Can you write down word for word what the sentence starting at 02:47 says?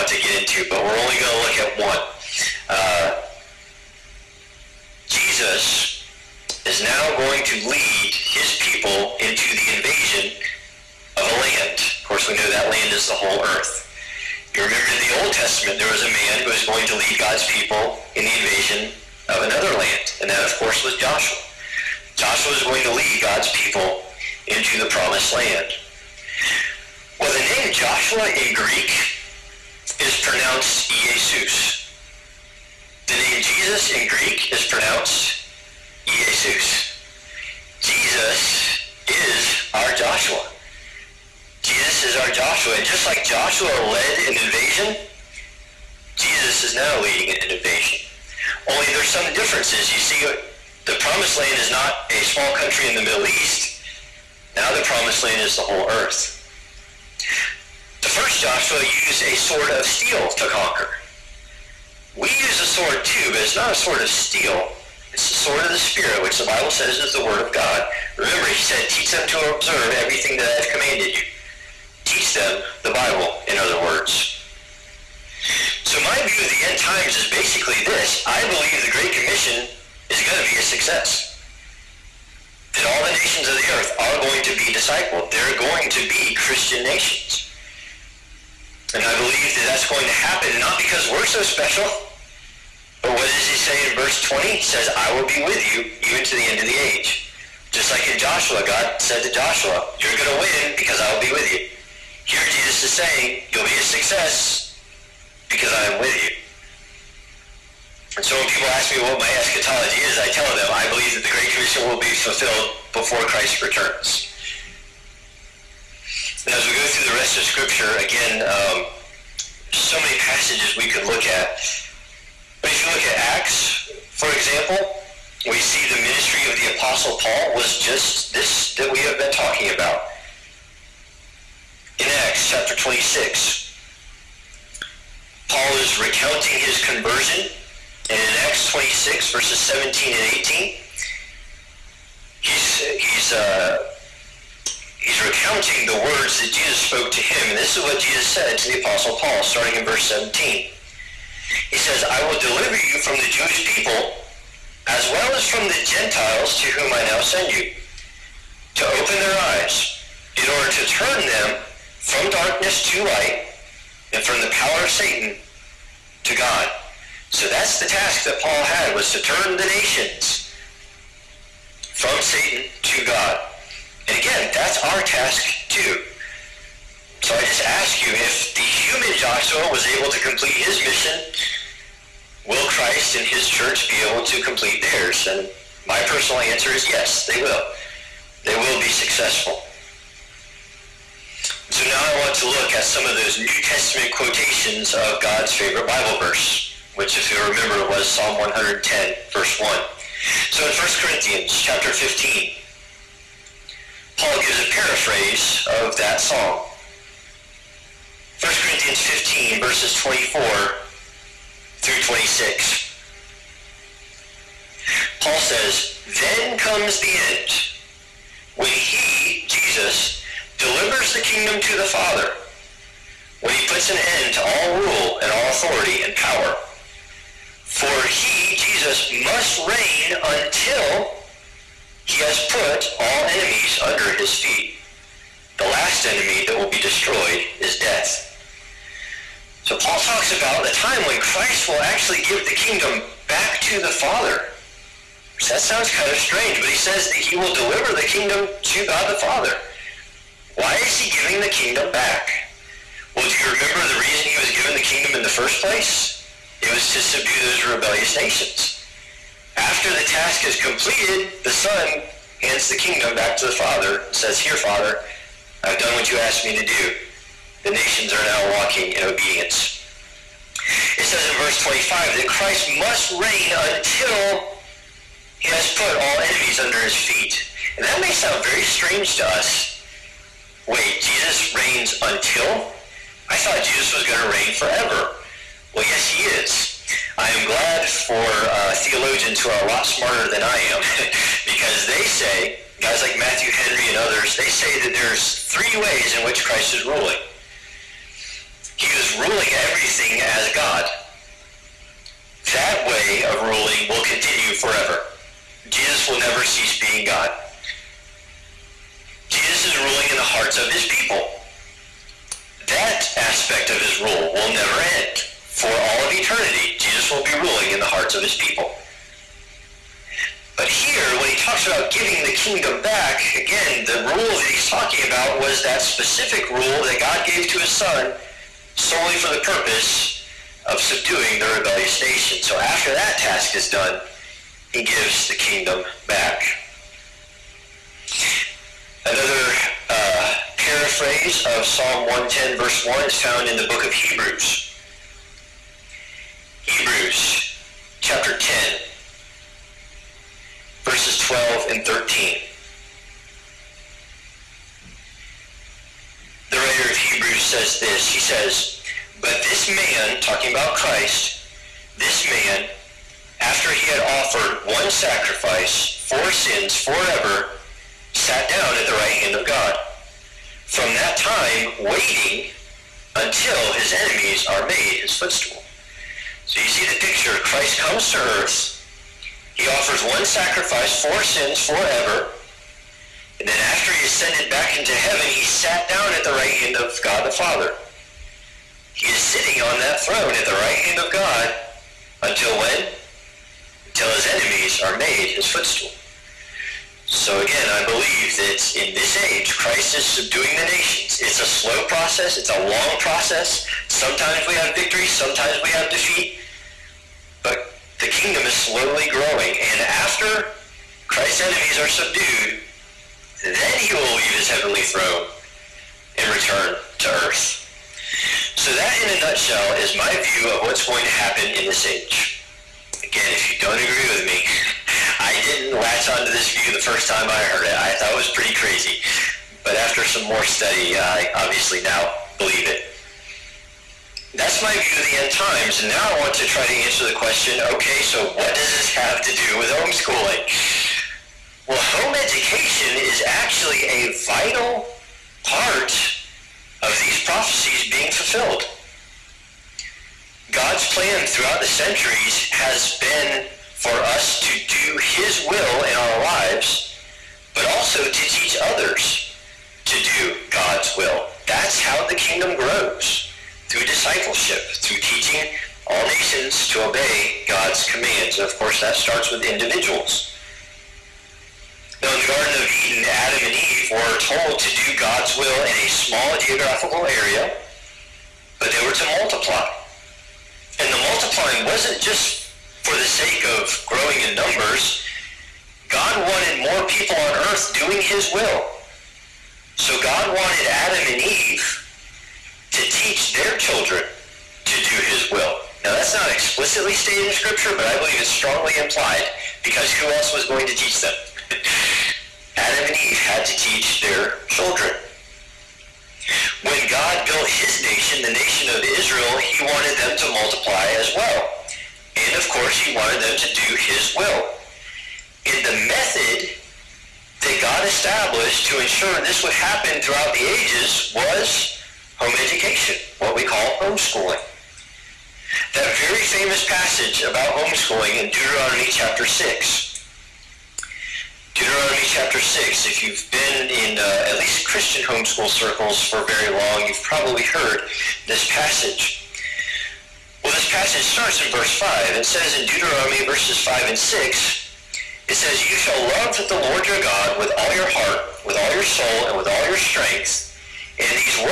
So that's the task that Paul had was to turn the nations from Satan to God.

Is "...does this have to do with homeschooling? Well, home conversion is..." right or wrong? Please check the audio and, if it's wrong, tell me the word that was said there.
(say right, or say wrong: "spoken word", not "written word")
wrong: "education", not "conversion".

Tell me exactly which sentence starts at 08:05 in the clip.
God wanted more people on earth doing his will.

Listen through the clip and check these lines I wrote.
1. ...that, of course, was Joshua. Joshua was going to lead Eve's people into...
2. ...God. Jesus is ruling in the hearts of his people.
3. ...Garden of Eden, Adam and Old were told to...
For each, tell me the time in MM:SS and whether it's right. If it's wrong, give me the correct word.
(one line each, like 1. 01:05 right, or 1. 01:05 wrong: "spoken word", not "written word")
1. 00:20 wrong: "God", not "Eve"
2. 05:07 right
3. 07:52 wrong: "Eve", not "Old".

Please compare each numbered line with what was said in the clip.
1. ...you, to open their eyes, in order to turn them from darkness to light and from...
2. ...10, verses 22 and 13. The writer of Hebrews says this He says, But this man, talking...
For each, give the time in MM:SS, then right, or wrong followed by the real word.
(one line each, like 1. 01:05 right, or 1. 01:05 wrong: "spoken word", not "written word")
1. 02:37 right
2. 05:48 wrong: "12", not "22".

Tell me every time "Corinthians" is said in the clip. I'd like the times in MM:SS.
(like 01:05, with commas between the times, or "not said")
03:20, 03:28.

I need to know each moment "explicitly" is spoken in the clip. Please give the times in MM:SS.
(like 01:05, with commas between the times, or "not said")
08:16.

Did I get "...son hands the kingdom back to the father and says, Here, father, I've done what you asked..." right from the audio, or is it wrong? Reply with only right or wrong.
right.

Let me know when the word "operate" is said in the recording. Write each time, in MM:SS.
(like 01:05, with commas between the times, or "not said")
not said.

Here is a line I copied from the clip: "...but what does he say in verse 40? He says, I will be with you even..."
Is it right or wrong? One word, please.
wrong.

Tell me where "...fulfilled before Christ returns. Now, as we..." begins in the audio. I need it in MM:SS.
01:52.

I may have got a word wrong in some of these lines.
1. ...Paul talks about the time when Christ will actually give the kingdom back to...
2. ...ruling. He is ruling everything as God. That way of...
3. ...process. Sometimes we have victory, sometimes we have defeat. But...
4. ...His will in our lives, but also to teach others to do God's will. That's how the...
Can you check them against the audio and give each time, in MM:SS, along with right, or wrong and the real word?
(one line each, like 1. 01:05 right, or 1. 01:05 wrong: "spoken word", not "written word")
1. 03:59 right
2. 04:56 right
3. 06:42 right
4. 07:35 right.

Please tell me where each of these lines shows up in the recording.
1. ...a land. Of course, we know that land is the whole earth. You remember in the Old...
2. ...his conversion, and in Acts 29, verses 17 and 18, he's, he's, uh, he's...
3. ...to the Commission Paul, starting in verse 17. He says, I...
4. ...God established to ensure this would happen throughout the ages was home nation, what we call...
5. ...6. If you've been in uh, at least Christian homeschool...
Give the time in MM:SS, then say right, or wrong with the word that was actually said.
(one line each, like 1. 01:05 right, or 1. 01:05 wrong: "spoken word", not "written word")
1. 00:11 right
2. 02:16 wrong: "26", not "29"
3. 02:28 wrong: "Apostle", not "Commission"
4. 08:37 wrong: "education", not "nation"
5. 08:52 right.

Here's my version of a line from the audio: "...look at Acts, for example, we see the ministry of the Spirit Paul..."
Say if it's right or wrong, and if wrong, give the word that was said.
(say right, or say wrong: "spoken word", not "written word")
wrong: "Apostle", not "Spirit".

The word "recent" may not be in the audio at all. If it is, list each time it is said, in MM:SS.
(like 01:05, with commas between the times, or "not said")
not said.